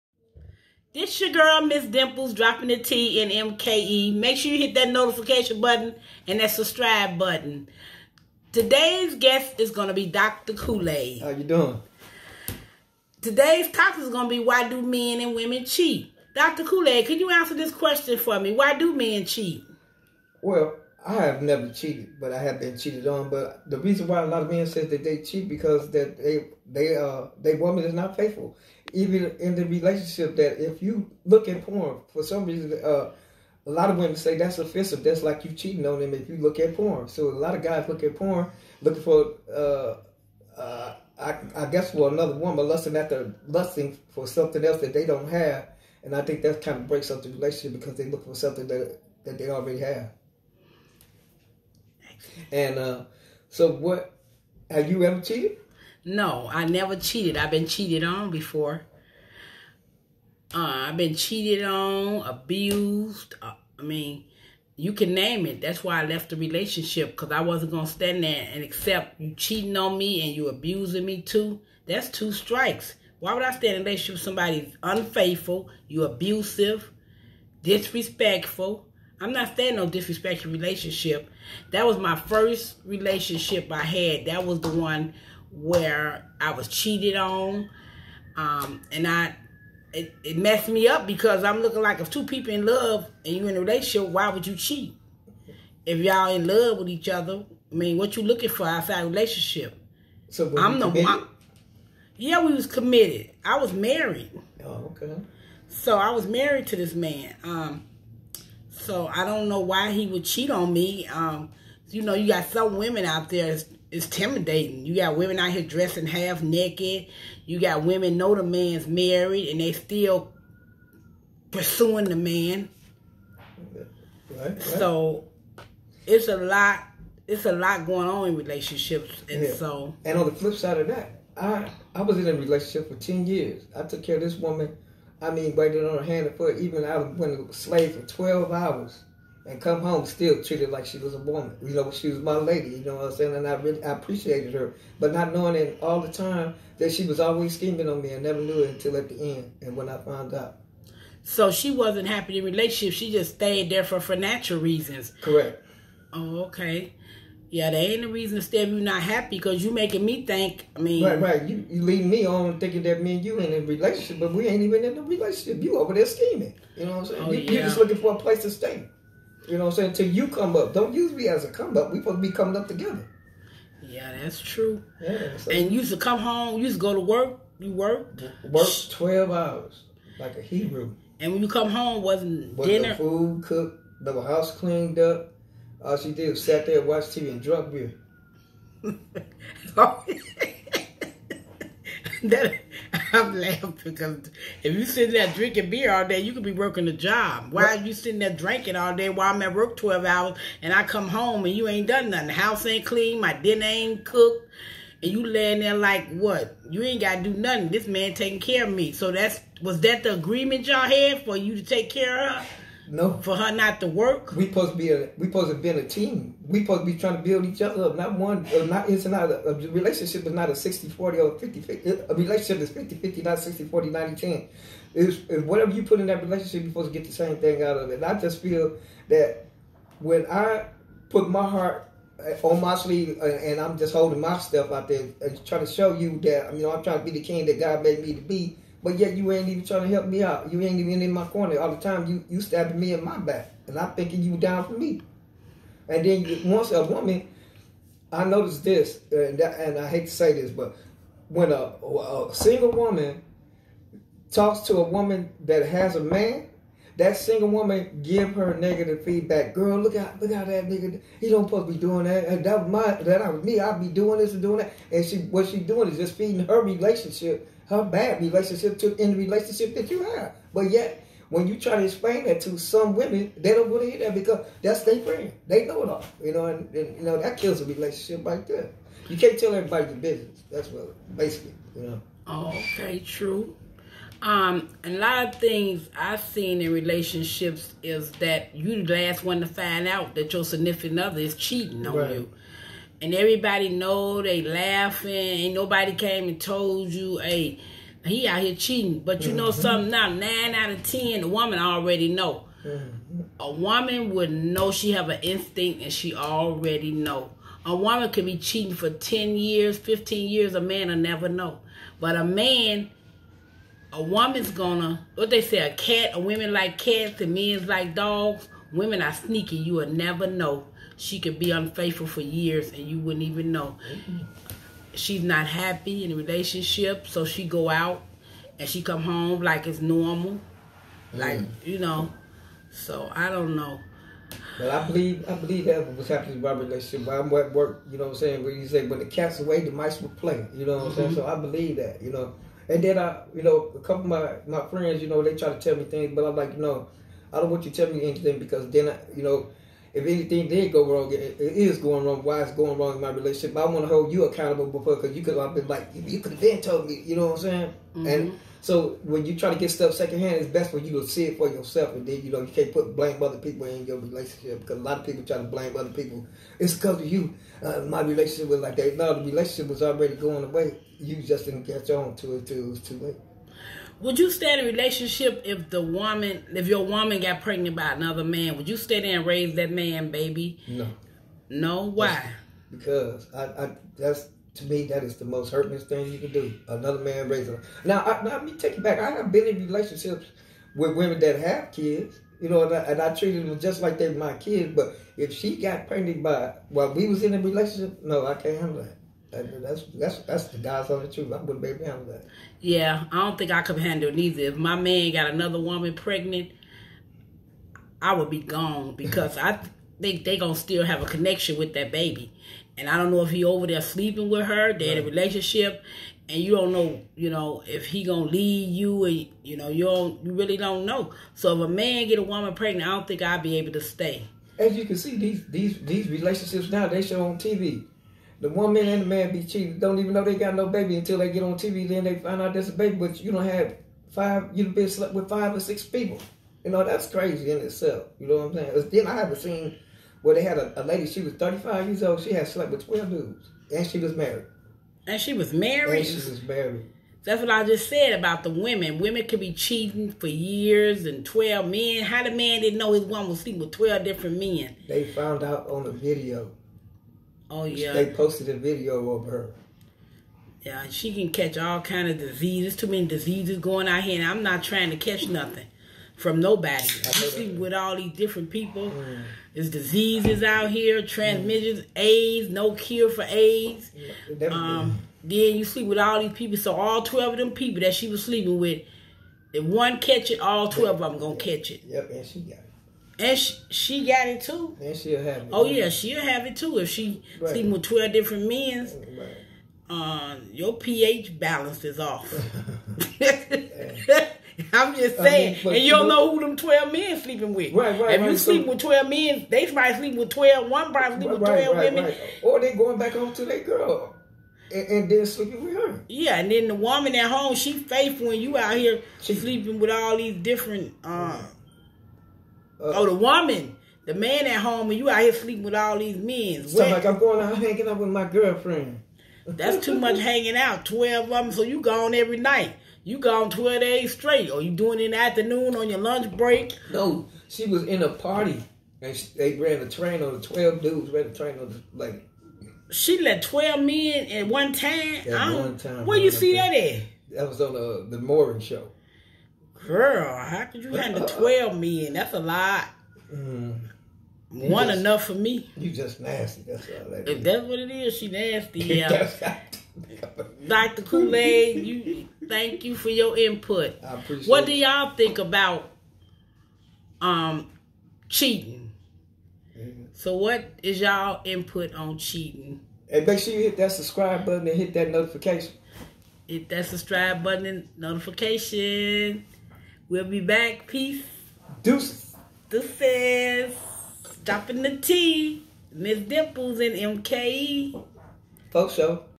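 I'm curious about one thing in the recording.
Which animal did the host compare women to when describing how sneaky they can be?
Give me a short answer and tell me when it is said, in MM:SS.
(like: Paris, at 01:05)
cats, at 05:16.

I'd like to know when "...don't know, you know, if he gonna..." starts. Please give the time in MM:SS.
06:56.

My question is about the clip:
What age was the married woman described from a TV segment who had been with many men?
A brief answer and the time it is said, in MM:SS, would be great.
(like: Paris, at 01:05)
35, at 07:21.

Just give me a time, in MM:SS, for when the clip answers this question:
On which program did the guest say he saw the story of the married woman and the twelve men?
08:58.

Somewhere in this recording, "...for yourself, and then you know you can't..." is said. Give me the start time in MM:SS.
06:01.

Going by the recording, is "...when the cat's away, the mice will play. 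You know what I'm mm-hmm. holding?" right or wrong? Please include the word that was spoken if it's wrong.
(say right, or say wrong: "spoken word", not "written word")
wrong: "saying", not "holding".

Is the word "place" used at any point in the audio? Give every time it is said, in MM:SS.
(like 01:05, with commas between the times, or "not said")
02:48.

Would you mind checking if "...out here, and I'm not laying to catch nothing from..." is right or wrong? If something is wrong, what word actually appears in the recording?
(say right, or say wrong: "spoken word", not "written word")
wrong: "trying", not "laying".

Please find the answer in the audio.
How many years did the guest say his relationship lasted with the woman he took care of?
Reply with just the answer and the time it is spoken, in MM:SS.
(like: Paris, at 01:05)
10, at 02:12.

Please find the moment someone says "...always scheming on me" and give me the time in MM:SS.
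02:27.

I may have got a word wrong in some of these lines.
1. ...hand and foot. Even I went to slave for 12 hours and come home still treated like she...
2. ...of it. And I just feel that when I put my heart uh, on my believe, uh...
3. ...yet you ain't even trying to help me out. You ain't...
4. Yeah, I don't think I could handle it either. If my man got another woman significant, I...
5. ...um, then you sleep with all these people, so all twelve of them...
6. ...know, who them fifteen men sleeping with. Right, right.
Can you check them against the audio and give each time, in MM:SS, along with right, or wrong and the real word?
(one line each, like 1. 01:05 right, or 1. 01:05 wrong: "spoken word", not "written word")
1. 02:16 right
2. 03:47 wrong: "sleeve", not "believe"
3. 03:58 right
4. 06:42 wrong: "pregnant", not "significant"
5. 07:54 right
6. 08:16 wrong: "twelve", not "fifteen".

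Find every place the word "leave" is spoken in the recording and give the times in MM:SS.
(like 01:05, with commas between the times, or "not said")
02:41, 06:58.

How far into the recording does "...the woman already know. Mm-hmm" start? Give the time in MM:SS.
05:01.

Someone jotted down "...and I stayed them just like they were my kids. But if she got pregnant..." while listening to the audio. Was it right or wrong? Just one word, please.
wrong.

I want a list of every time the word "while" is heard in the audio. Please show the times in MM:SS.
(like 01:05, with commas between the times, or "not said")
03:19, 06:36.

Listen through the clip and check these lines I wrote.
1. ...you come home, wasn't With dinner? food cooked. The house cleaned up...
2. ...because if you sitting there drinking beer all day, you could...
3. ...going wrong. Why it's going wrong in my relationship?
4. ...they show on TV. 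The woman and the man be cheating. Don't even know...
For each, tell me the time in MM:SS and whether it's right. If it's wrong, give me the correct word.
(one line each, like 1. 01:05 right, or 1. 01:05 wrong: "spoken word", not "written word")
1. 03:01 right
2. 03:13 right
3. 05:51 right
4. 07:06 right.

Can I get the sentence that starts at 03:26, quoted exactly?
You ain't got to do nothing.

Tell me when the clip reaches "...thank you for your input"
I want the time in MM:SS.
09:12.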